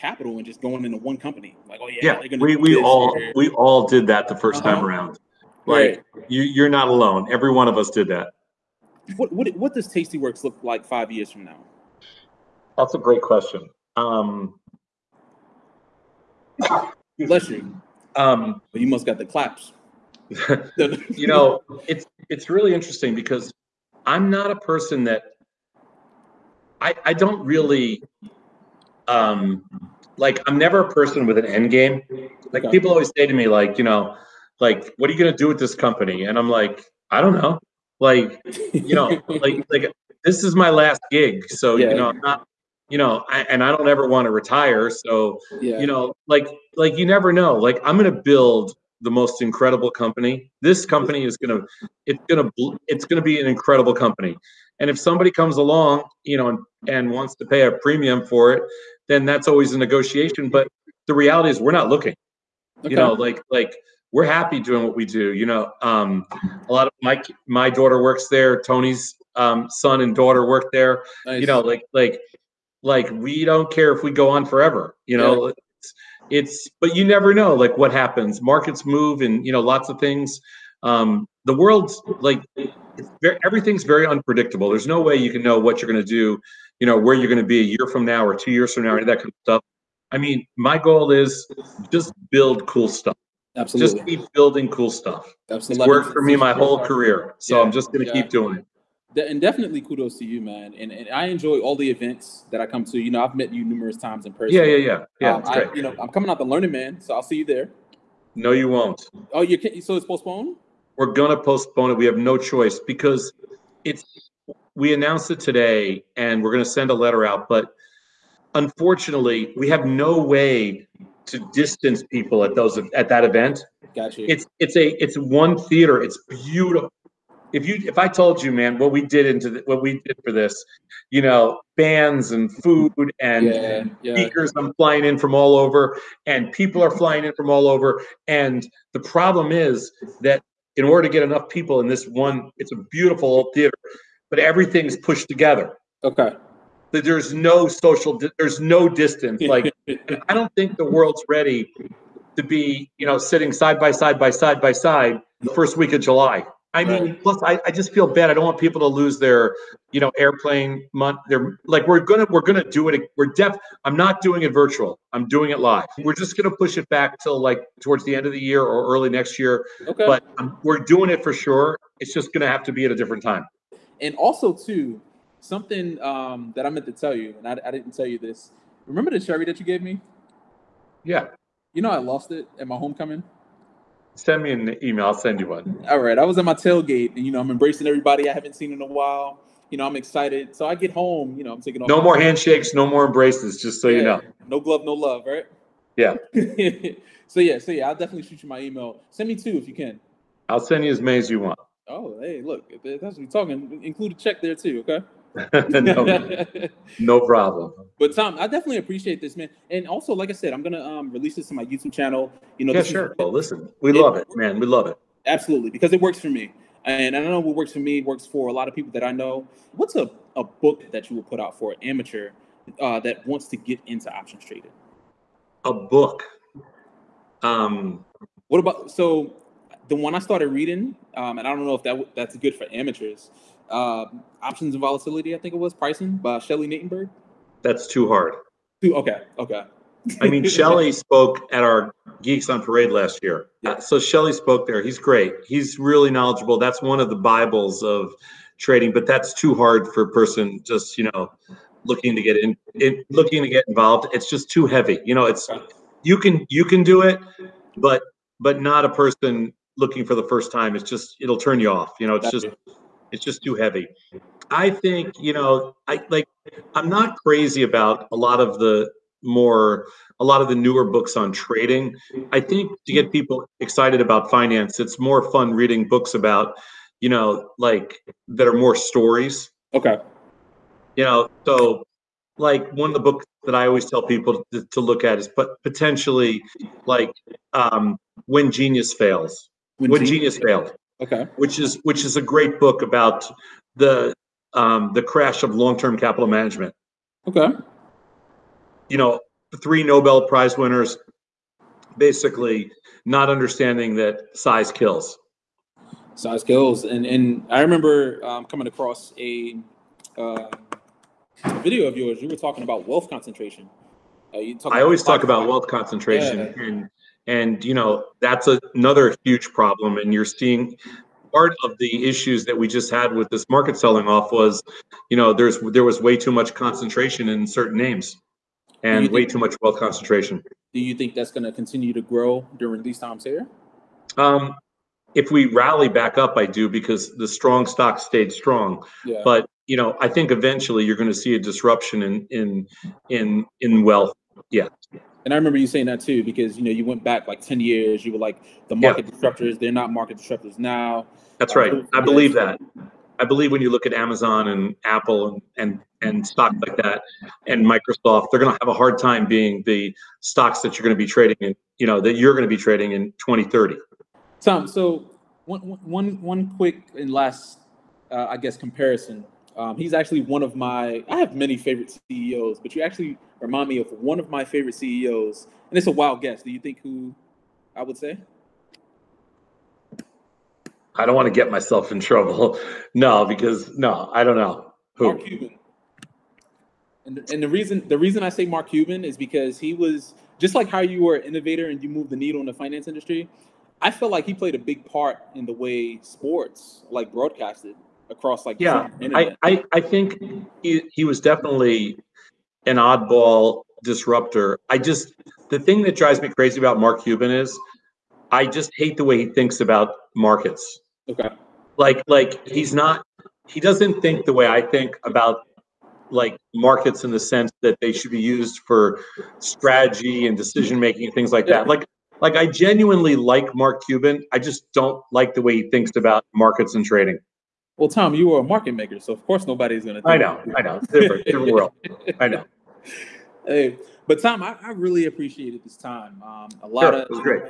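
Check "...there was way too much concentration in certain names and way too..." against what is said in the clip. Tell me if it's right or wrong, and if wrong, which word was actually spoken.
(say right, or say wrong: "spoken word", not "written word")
right.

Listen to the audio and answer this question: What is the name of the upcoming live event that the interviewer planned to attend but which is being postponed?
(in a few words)
Learning Man.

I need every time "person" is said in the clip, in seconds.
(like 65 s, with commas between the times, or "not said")
24 s, 30 s, 104 s, 250 s, 258 s.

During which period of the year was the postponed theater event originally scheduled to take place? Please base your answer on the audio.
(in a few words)
First week of July.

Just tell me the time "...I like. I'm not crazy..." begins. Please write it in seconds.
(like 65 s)
265 s.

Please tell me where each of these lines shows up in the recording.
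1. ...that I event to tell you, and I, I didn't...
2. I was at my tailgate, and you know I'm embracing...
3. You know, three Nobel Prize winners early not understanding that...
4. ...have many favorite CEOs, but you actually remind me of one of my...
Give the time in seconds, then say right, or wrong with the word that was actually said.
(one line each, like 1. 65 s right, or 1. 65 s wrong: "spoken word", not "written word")
1. 176 s wrong: "meant", not "event"
2. 186 s right
3. 298 s wrong: "basically", not "early"
4. 371 s right.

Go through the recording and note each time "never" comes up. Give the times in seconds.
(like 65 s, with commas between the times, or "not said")
30 s, 47 s, 77 s.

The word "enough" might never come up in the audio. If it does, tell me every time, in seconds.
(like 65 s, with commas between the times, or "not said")
141 s.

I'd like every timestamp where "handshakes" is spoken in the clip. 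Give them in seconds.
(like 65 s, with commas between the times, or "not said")
192 s.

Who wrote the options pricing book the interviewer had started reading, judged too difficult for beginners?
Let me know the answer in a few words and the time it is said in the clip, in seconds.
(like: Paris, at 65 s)
Shelley Natenberg, at 236 s.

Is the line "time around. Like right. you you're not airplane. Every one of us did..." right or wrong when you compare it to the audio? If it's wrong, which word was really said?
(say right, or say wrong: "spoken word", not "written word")
wrong: "alone", not "airplane".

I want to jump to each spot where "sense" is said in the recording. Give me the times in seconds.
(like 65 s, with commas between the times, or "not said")
417 s.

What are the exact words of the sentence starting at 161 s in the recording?
They're like, we're gonna we're gonna do it.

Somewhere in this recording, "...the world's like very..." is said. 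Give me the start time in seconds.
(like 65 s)
81 s.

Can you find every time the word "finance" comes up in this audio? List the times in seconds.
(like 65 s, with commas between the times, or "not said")
274 s, 392 s.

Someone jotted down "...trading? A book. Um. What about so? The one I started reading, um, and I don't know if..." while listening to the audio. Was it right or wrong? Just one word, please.
right.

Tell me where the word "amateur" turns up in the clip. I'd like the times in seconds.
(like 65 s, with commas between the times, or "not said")
221 s, 232 s.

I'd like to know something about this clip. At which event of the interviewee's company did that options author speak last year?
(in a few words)
Geeks on Parade.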